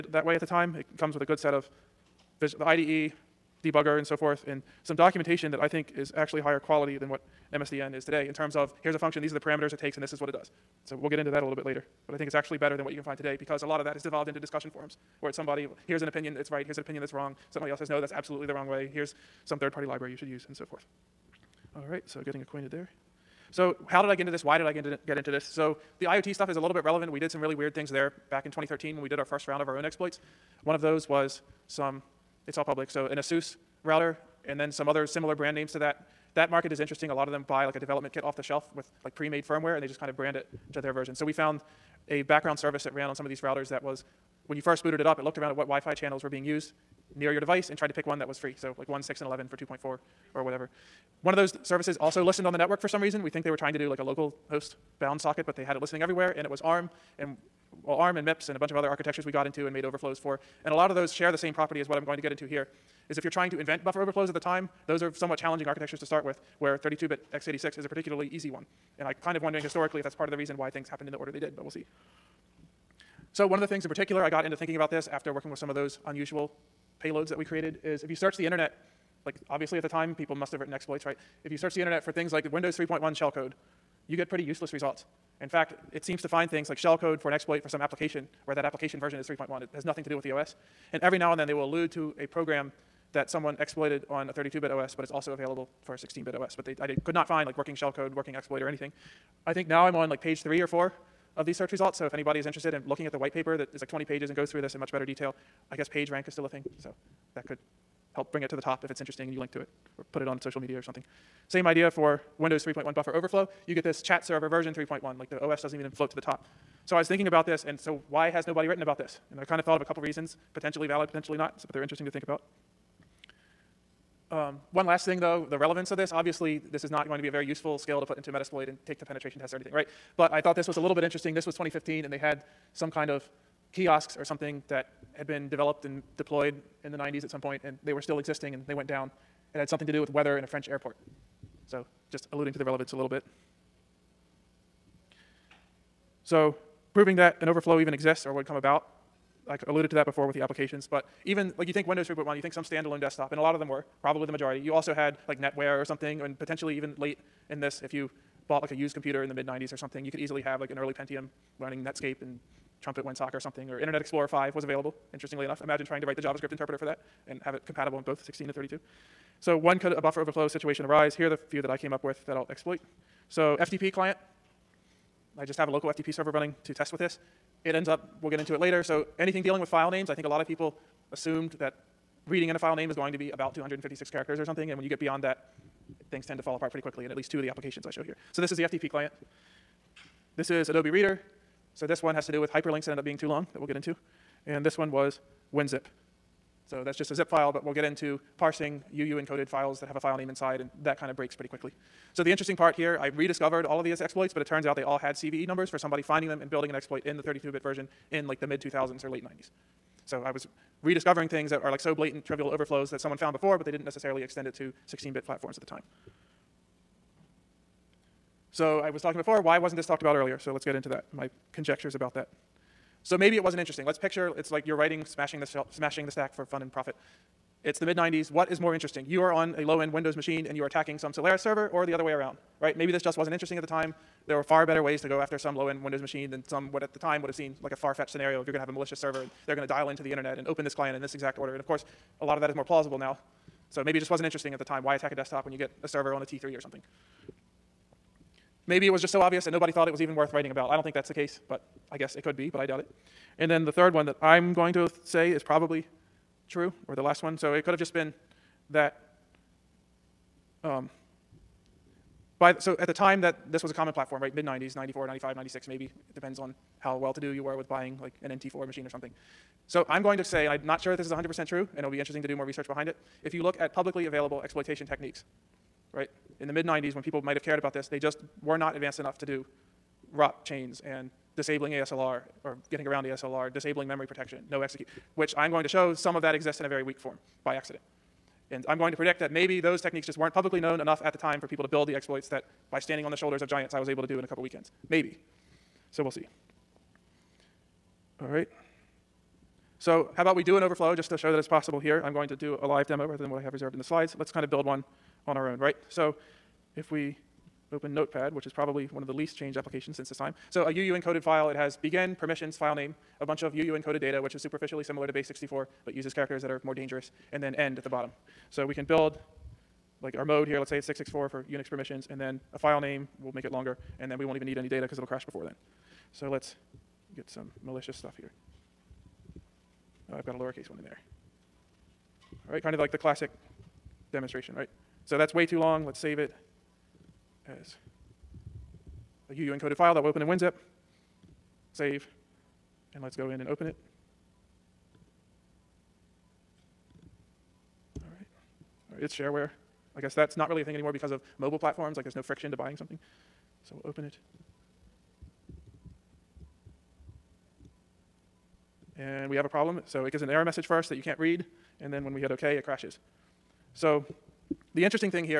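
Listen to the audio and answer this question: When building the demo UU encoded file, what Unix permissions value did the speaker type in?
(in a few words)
664.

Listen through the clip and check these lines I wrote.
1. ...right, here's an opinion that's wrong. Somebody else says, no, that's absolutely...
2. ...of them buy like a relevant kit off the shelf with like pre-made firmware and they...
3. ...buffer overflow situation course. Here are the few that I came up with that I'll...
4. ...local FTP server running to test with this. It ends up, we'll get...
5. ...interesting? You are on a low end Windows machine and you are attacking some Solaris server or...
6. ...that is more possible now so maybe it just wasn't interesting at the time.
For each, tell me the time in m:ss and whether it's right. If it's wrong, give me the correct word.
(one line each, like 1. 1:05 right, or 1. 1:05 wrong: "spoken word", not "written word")
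1. 0:16 right
2. 0:37 wrong: "development", not "relevant"
3. 2:49 wrong: "arise", not "course"
4. 2:55 right
5. 3:48 right
6. 4:02 wrong: "plausible", not "possible".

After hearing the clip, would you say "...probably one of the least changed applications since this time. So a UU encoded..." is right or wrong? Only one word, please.
right.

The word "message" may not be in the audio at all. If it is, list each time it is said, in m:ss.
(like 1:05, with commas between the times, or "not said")
6:00.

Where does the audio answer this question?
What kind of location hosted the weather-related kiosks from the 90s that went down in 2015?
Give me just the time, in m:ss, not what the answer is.
2:20.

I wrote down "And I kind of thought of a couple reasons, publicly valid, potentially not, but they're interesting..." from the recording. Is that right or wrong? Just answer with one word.
wrong.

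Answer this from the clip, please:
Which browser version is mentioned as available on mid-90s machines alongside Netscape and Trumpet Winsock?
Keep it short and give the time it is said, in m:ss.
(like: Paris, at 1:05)
Internet Explorer 5, at 2:43.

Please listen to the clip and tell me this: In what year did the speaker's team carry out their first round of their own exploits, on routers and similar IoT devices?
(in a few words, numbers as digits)
2013.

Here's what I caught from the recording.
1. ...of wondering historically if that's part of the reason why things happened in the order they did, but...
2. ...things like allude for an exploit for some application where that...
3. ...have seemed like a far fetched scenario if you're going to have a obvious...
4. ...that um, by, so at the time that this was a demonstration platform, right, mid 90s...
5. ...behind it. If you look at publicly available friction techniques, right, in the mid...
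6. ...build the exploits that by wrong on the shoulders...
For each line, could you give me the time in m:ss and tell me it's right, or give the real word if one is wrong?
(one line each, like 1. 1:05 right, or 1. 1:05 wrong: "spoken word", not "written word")
1. 1:09 right
2. 1:26 wrong: "shellcode", not "allude"
3. 3:57 wrong: "malicious", not "obvious"
4. 4:18 wrong: "common", not "demonstration"
5. 4:32 wrong: "exploitation", not "friction"
6. 4:51 wrong: "standing", not "wrong".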